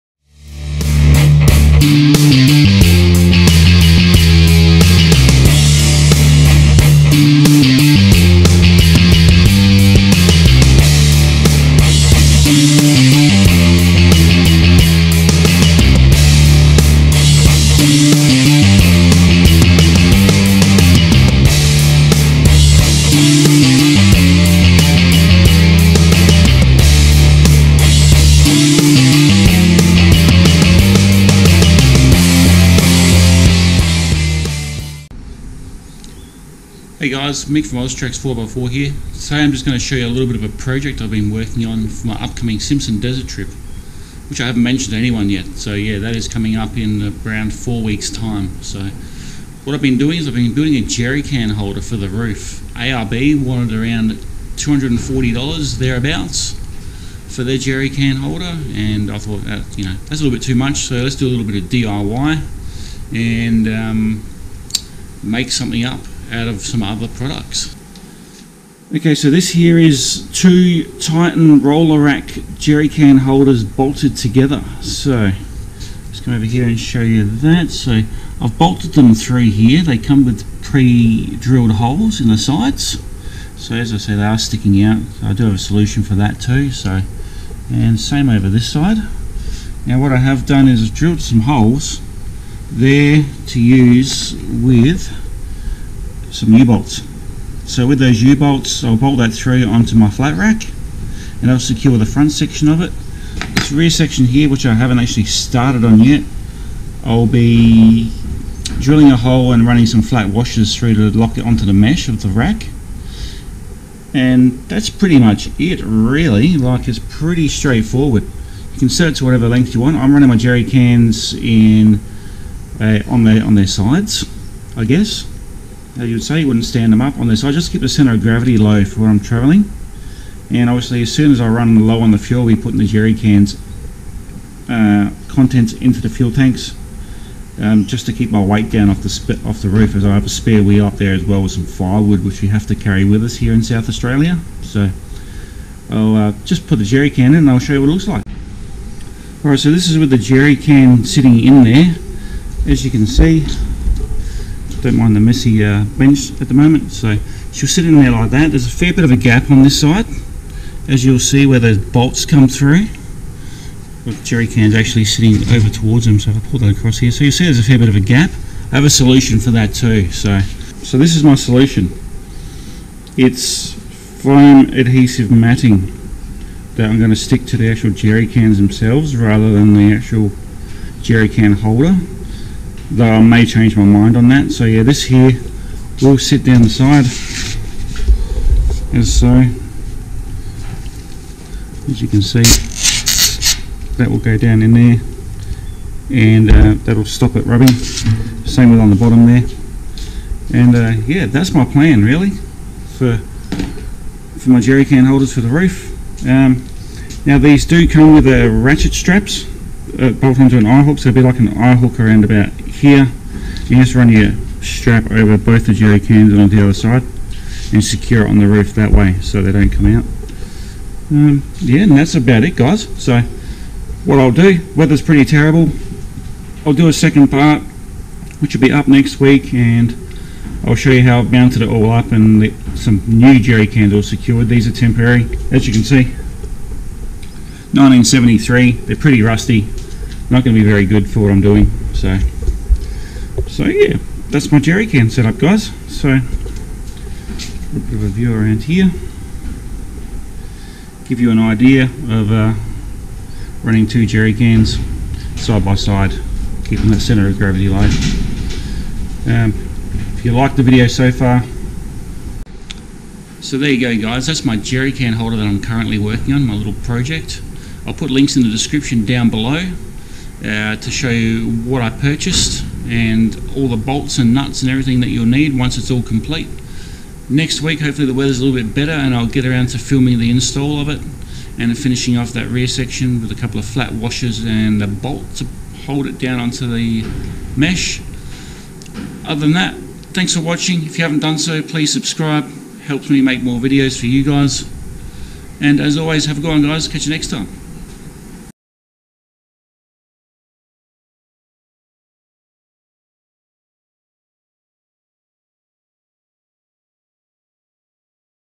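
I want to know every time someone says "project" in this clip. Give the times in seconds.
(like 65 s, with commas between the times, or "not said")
40 s, 266 s.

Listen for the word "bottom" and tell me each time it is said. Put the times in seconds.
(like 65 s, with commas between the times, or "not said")
198 s.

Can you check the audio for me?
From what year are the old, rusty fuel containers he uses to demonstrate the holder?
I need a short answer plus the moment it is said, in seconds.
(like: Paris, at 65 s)
1973, at 237 s.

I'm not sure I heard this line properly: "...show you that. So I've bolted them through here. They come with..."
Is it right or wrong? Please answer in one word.
right.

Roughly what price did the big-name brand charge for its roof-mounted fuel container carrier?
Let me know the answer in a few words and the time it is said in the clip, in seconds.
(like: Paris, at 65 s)
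$240, at 54 s.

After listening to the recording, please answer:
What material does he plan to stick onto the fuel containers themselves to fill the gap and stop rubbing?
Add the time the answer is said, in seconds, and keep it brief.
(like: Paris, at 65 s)
Foam adhesive matting, at 174 s.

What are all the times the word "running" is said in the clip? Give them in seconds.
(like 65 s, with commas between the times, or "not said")
109 s, 120 s, 253 s.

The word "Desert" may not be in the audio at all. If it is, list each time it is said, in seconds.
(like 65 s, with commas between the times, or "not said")
42 s.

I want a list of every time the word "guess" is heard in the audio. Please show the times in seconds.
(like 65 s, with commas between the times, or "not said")
124 s.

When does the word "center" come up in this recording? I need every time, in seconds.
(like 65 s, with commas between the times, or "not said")
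127 s, 256 s.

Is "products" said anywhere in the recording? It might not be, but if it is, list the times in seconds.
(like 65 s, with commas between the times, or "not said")
67 s.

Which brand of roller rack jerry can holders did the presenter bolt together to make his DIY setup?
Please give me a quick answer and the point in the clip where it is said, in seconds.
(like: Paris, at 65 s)
Titan, at 70 s.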